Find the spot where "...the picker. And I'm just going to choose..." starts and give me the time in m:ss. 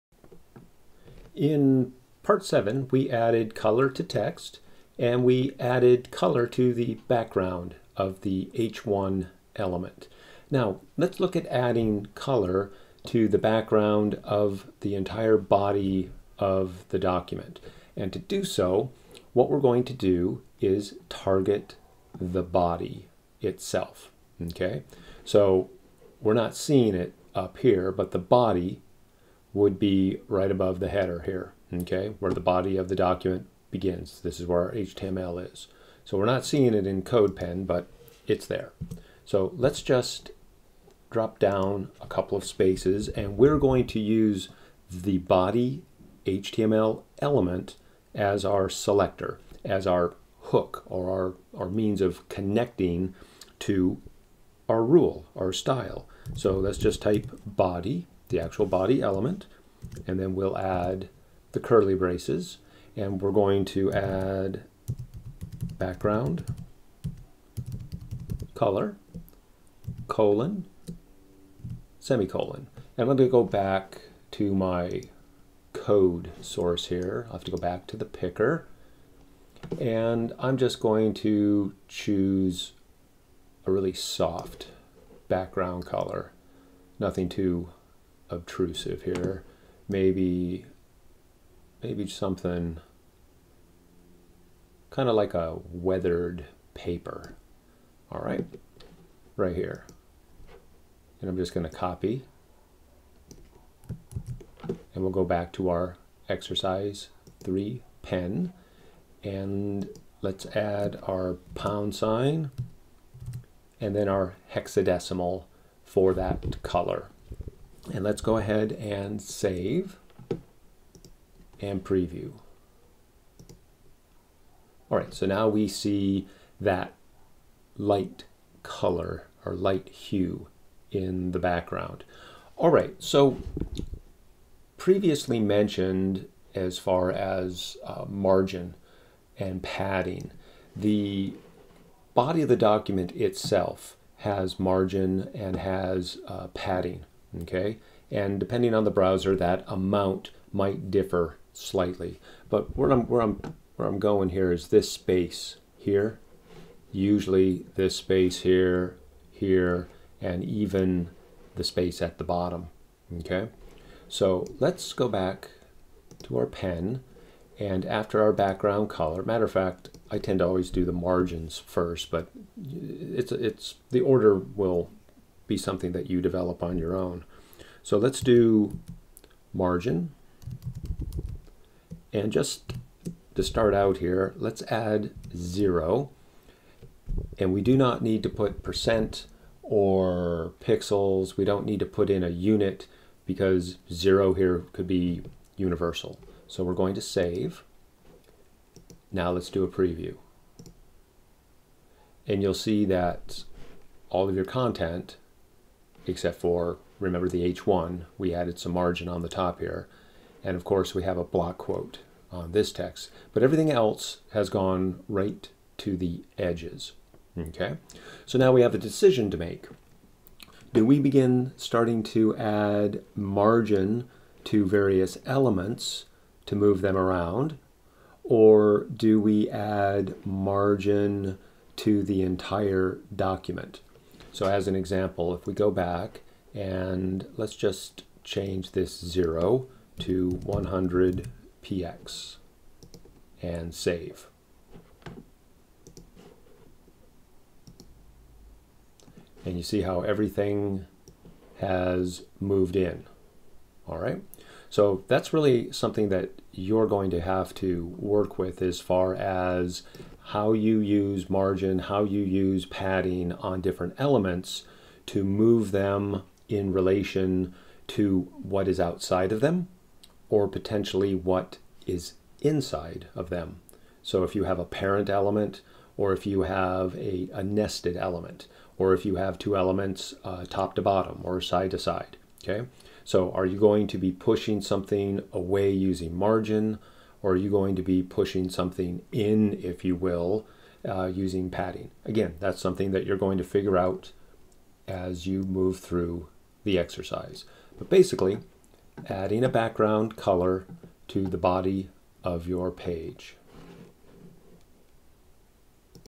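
1:17.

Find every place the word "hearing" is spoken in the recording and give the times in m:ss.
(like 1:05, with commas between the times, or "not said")
not said.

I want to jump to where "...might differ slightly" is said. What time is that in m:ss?
2:30.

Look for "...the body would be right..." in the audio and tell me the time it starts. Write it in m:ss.
0:28.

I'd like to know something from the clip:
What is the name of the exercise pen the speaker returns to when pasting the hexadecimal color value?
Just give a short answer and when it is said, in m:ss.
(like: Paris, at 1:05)
exercise three, at 1:46.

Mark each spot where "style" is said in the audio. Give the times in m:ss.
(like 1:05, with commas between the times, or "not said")
0:55.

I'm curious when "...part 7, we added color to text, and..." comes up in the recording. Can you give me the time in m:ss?
0:02.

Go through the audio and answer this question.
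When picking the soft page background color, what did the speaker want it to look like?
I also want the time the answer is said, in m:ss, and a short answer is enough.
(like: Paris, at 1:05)
weathered paper, at 1:35.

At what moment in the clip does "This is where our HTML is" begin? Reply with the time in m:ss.
0:34.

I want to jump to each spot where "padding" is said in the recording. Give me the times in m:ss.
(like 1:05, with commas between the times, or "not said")
2:19, 2:26, 4:22, 4:51.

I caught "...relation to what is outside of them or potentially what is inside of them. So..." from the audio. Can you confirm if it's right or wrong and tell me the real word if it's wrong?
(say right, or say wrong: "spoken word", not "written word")
right.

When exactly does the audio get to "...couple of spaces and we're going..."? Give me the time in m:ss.
0:42.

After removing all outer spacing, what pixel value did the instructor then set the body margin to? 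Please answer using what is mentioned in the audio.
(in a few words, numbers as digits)
100 px.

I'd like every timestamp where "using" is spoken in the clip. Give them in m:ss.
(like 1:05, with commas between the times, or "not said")
4:45, 4:51.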